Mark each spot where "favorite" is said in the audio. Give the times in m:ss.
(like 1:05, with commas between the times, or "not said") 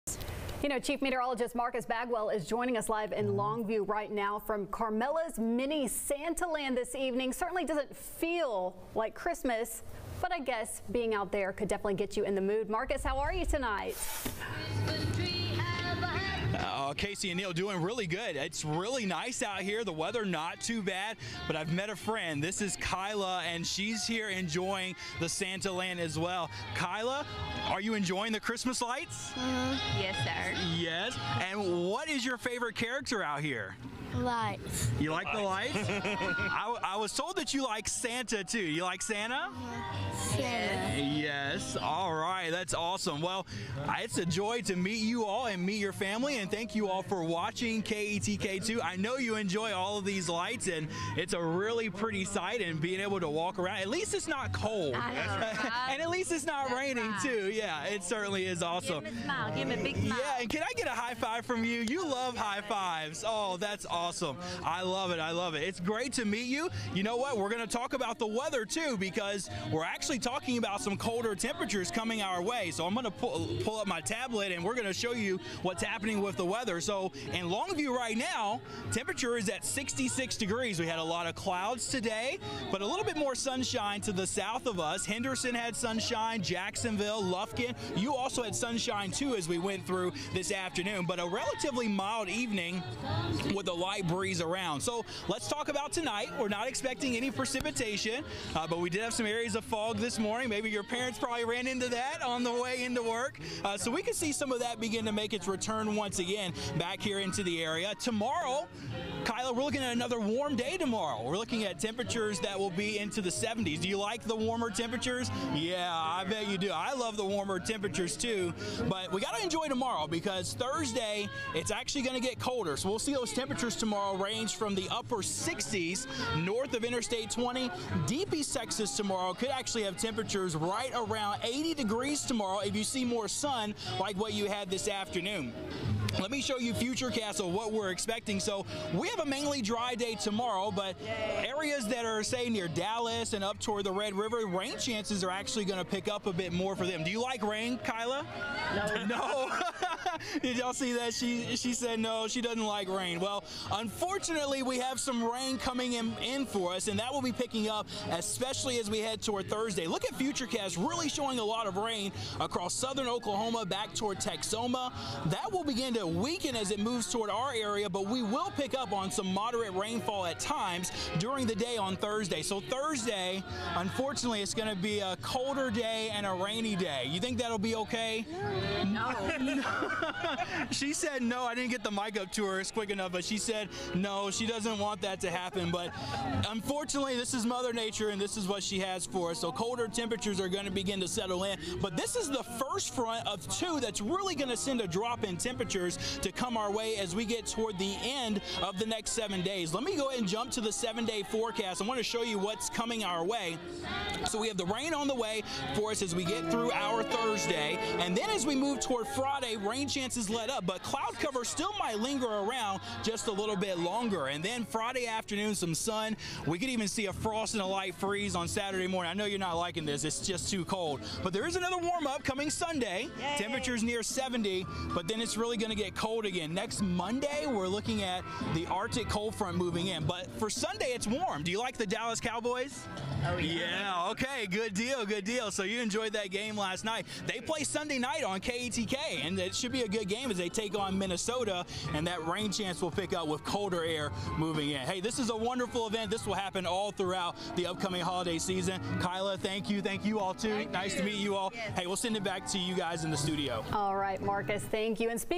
0:32.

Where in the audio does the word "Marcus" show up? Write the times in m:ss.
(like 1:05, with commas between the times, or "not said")
0:01, 0:12, 4:14.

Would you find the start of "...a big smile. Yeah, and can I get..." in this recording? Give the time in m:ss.
0:59.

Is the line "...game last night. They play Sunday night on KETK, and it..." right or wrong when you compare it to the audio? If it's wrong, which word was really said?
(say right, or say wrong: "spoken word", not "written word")
right.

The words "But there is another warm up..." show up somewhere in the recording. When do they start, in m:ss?
3:41.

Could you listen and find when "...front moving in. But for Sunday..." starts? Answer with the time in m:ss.
3:49.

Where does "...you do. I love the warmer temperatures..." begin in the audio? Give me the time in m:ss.
1:56.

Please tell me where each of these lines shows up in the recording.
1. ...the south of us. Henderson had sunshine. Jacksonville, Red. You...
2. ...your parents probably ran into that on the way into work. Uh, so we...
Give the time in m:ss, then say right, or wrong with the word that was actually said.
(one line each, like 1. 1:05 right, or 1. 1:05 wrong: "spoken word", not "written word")
1. 1:24 wrong: "Lufkin", not "Red"
2. 1:40 right.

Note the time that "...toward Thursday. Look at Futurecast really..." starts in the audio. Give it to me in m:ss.
2:39.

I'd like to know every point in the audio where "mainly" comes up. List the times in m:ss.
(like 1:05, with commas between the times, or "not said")
2:19.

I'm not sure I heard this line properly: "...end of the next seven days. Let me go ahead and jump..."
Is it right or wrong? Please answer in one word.
right.